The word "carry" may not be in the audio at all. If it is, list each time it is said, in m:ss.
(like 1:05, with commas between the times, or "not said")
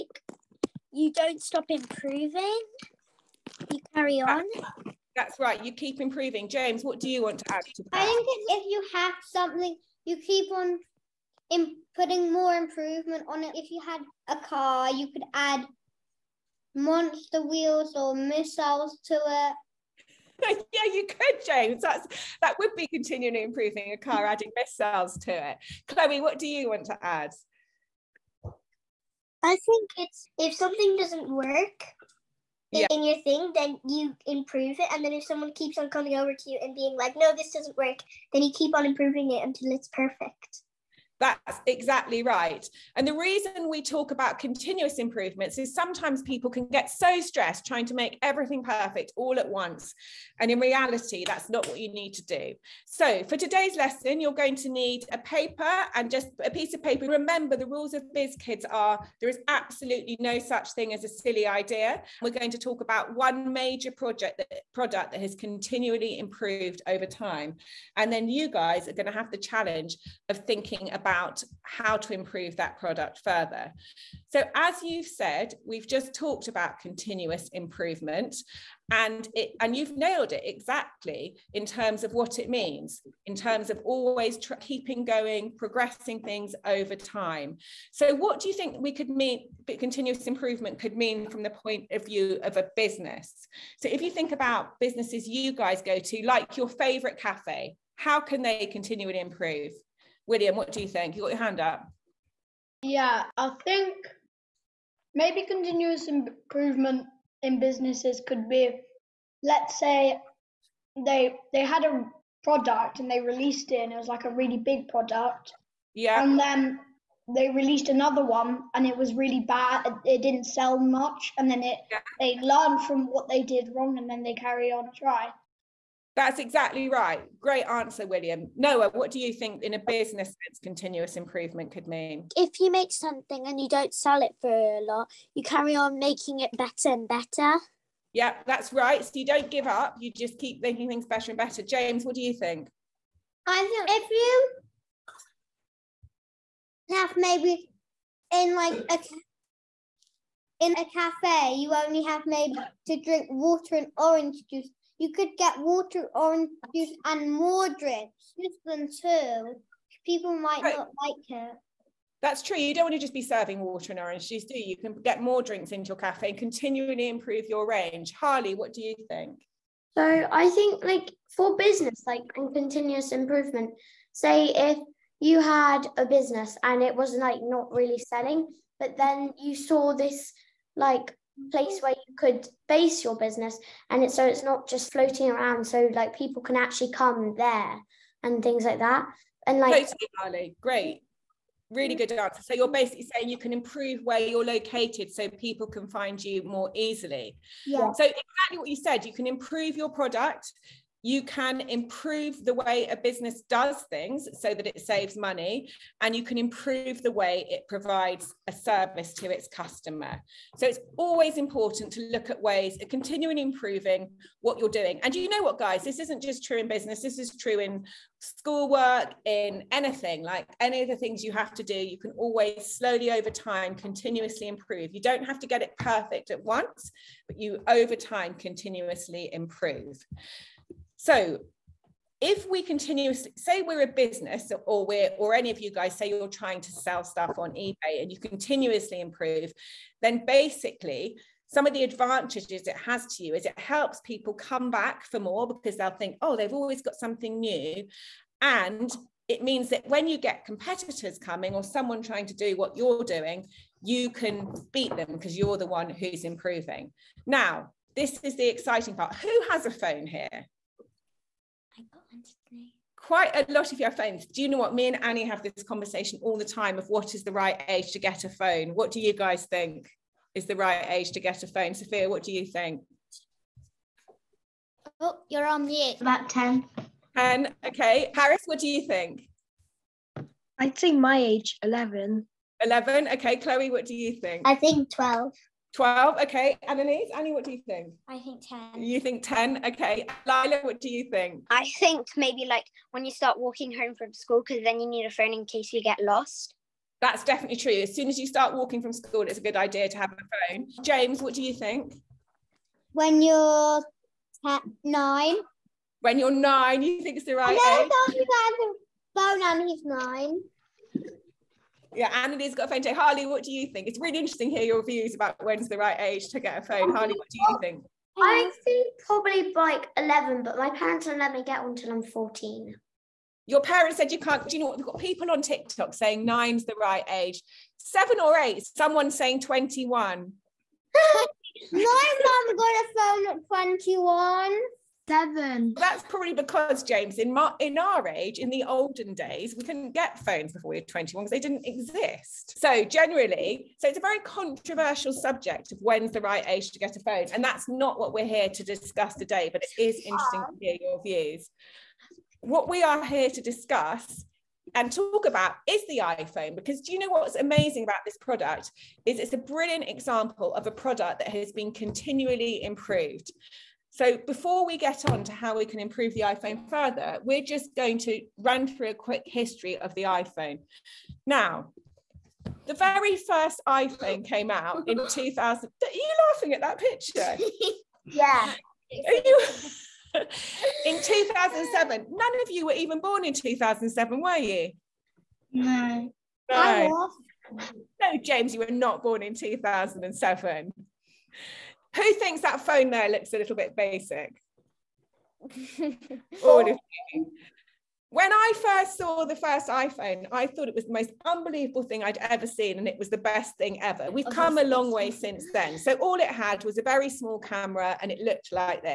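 0:03, 2:04, 2:15.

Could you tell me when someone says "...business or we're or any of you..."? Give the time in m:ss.
3:53.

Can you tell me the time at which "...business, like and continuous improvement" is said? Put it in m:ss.
2:51.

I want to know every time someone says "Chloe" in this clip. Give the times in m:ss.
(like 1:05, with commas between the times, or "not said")
0:25, 4:43.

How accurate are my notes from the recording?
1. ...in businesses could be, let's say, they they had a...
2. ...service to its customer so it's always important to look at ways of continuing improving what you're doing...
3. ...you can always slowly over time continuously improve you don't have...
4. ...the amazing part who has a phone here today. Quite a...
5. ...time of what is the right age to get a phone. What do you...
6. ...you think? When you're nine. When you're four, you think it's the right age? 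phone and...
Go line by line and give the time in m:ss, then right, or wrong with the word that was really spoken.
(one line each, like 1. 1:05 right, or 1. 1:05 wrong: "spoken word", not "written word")
1. 1:47 right
2. 3:28 right
3. 3:41 right
4. 4:18 wrong: "exciting", not "amazing"
5. 4:26 right
6. 5:01 wrong: "nine", not "four".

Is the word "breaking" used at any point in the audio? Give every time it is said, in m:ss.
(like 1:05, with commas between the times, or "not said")
not said.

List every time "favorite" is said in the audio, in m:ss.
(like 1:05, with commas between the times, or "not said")
1:36.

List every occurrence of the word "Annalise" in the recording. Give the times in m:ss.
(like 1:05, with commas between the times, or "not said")
4:46, 5:12.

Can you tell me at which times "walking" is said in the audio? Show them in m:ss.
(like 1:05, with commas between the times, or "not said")
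4:53, 4:58.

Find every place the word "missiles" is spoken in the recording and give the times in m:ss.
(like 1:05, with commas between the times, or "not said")
0:18, 0:24.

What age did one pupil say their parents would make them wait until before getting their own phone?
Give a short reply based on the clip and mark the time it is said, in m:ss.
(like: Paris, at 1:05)
14, at 5:22.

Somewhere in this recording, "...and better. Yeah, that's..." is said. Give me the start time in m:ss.
2:16.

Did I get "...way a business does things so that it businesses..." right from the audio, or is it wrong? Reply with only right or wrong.
wrong.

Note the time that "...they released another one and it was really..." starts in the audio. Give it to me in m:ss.
1:57.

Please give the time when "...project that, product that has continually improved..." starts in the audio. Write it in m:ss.
1:03.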